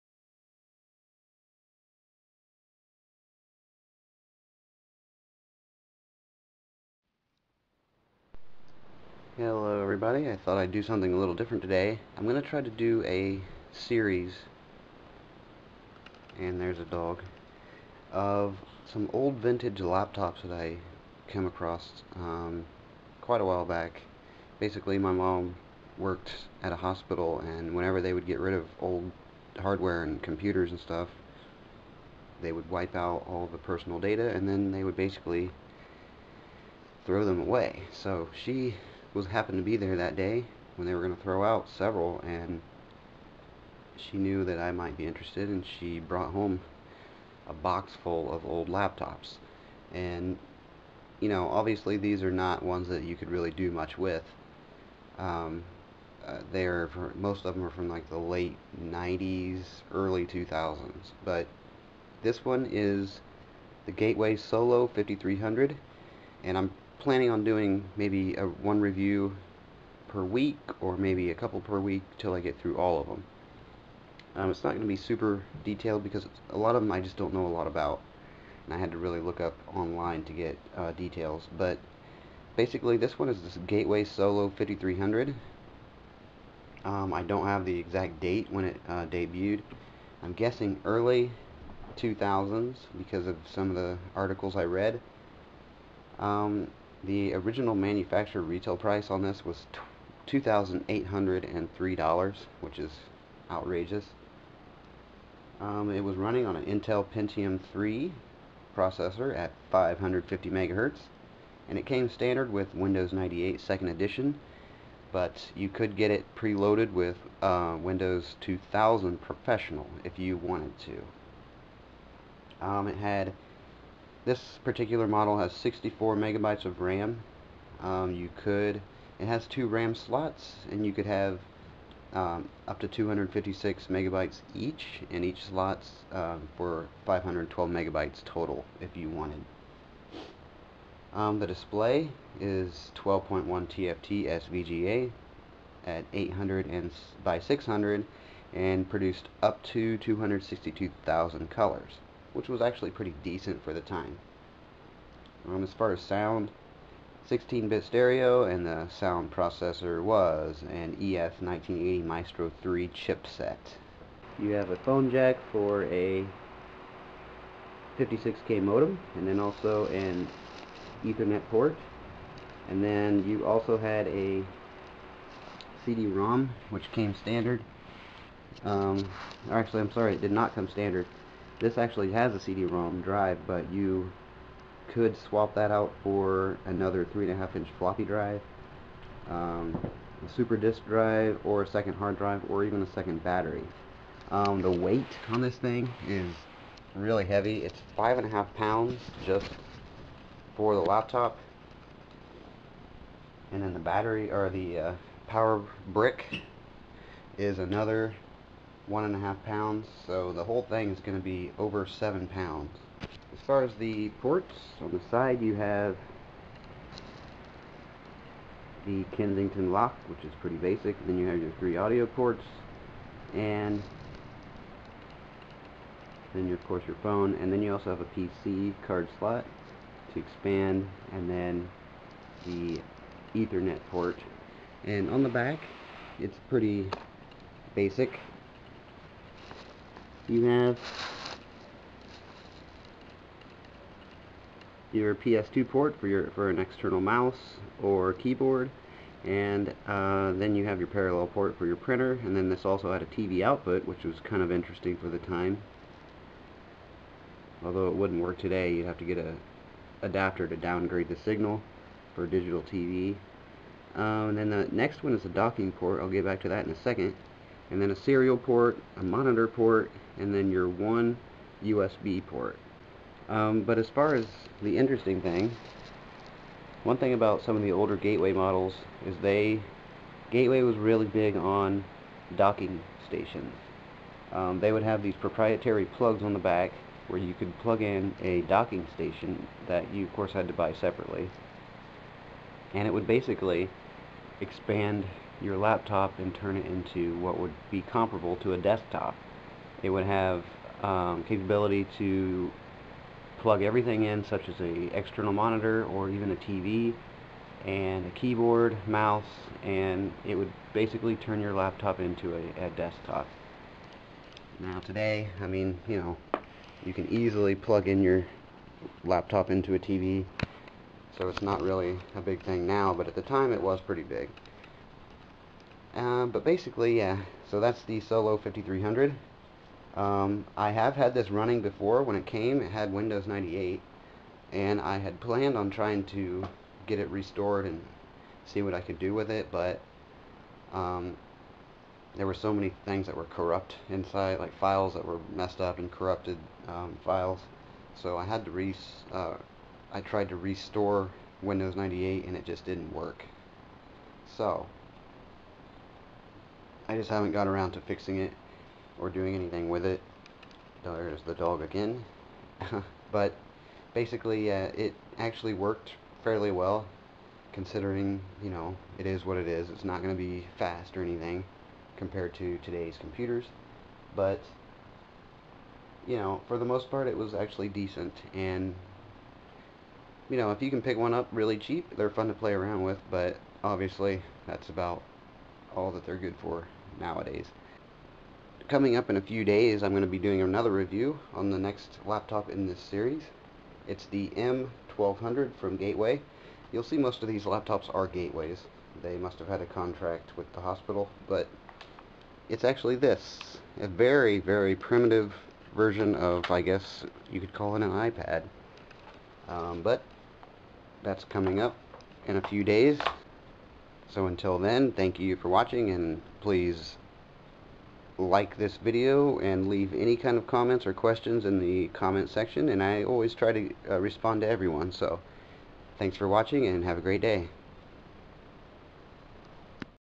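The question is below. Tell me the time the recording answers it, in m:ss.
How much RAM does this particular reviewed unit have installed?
2:05.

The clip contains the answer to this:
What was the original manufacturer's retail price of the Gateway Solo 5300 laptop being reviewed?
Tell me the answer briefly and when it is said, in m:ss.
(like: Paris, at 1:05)
$2,803, at 1:40.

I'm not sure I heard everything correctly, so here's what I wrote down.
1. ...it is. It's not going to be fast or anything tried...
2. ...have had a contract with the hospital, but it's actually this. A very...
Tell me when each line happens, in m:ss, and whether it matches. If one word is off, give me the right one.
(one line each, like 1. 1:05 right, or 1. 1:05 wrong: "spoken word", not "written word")
1. 6:09 wrong: "compared", not "tried"
2. 6:39 right.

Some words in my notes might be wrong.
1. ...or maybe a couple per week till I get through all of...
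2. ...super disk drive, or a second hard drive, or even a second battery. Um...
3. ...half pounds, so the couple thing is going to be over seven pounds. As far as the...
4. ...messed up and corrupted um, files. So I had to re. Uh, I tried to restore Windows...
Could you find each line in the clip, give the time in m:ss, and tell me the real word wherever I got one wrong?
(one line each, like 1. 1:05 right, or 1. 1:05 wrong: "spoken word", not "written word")
1. 1:10 right
2. 3:10 right
3. 3:29 wrong: "whole", not "couple"
4. 5:45 right.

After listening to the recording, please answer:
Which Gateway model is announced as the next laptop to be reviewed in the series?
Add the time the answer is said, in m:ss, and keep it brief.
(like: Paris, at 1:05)
M1200, at 6:34.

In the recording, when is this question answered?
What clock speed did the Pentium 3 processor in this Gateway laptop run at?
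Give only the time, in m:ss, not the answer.
1:49.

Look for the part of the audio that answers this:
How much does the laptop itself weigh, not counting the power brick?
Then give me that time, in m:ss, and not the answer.
3:17.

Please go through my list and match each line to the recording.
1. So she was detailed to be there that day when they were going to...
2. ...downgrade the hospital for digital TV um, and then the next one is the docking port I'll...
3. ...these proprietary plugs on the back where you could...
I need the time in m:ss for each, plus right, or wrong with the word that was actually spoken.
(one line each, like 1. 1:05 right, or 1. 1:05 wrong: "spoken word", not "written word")
1. 0:37 wrong: "happened", not "detailed"
2. 4:20 wrong: "signal", not "hospital"
3. 4:45 right.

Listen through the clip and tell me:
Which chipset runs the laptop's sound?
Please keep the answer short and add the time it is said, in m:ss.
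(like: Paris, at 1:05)
ES1980 Maestro 3, at 2:41.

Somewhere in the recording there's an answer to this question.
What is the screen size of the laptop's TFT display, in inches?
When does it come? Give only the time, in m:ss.
2:22.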